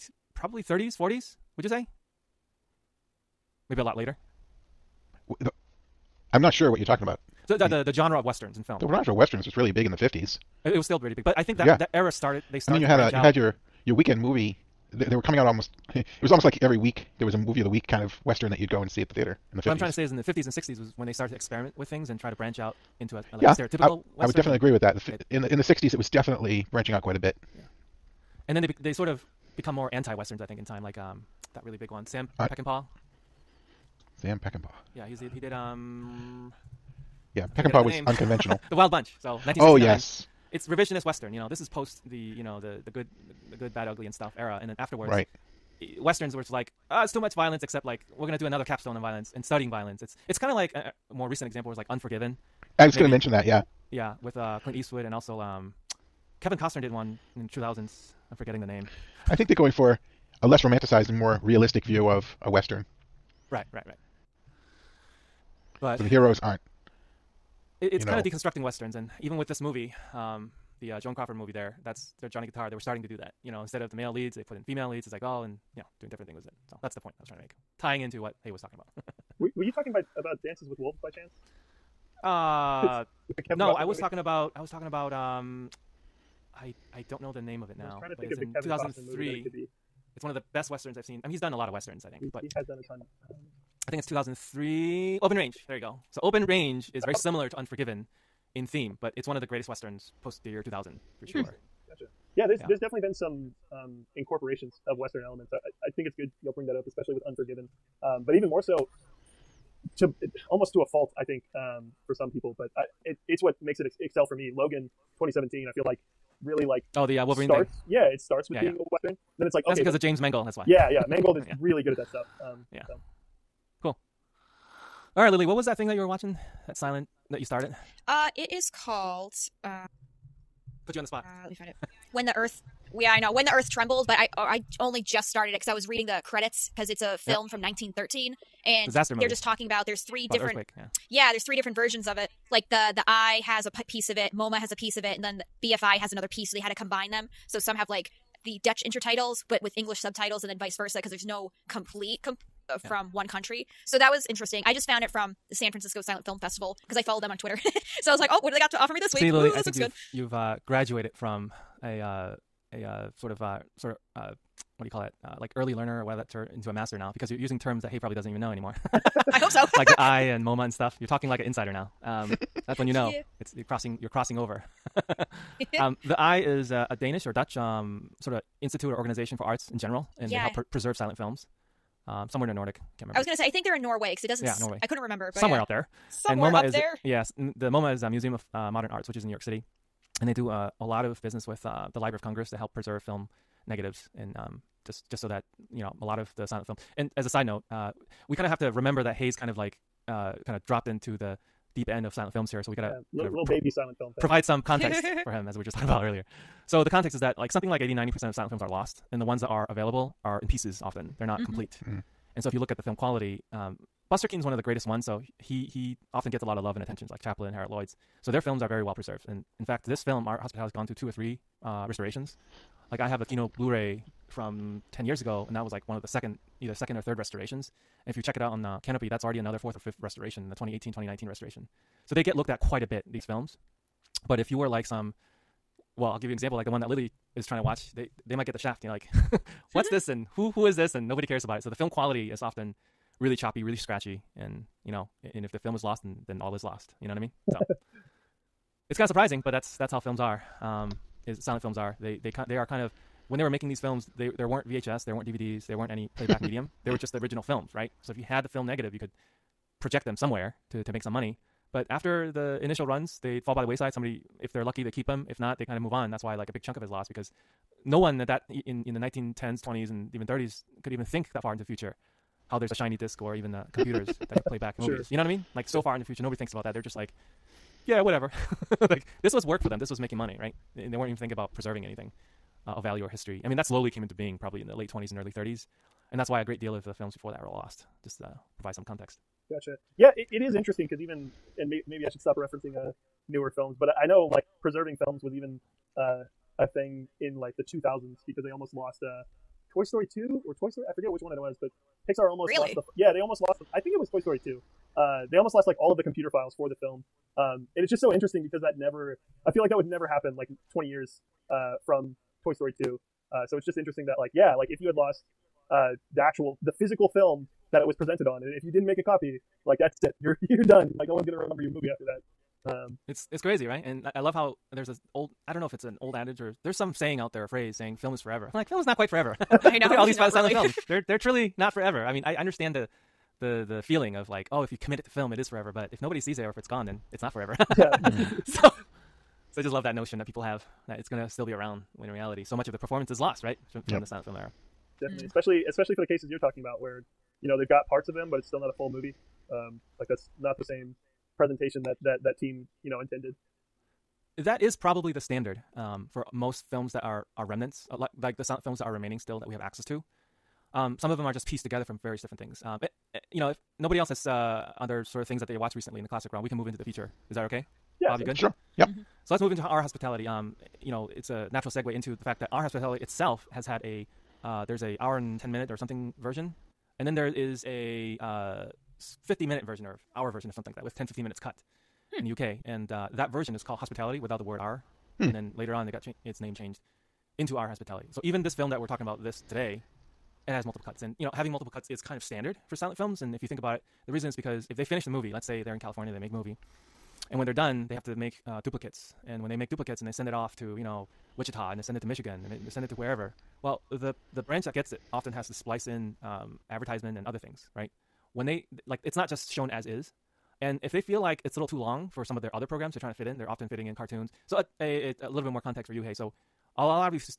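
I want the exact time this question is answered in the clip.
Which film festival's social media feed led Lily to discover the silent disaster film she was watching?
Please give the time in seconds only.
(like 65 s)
155 s.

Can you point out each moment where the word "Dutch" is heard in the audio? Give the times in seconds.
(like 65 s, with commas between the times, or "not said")
148 s, 177 s.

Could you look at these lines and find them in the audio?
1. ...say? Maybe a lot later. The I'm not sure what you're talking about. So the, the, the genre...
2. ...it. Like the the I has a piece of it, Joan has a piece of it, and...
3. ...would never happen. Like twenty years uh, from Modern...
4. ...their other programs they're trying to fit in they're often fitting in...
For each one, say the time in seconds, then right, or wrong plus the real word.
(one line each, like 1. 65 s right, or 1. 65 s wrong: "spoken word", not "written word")
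1. 1 s right
2. 142 s wrong: "MoMA", not "Joan"
3. 309 s wrong: "Toy", not "Modern"
4. 412 s right.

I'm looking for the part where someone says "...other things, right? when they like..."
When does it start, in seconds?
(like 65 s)
407 s.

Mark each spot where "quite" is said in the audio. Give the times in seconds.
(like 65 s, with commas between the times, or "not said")
27 s, 232 s, 328 s.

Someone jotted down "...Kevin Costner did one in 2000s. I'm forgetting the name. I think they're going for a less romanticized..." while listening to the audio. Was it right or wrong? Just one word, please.
right.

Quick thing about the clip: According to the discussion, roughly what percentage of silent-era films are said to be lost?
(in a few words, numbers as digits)
80-90%.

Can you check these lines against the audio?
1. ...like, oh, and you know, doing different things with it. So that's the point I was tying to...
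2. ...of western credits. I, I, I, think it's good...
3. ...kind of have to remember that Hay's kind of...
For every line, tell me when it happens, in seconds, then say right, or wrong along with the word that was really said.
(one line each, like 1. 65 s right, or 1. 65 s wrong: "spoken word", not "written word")
1. 75 s wrong: "trying", not "tying"
2. 104 s wrong: "elements", not "credits"
3. 198 s right.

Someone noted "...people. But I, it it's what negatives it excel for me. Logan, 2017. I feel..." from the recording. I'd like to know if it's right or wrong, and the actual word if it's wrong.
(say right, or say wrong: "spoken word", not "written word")
wrong: "makes", not "negatives".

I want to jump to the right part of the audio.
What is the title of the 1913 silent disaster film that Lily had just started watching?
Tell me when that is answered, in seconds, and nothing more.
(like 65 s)
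133 s.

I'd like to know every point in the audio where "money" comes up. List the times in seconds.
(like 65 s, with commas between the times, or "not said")
261 s, 280 s.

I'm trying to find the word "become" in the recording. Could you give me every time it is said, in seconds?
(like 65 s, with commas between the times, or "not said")
29 s.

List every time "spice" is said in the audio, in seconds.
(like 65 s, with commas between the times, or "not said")
not said.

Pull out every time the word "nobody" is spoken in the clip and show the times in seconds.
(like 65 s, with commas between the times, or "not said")
241 s, 276 s, 336 s, 363 s.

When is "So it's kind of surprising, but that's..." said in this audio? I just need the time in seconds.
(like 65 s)
247 s.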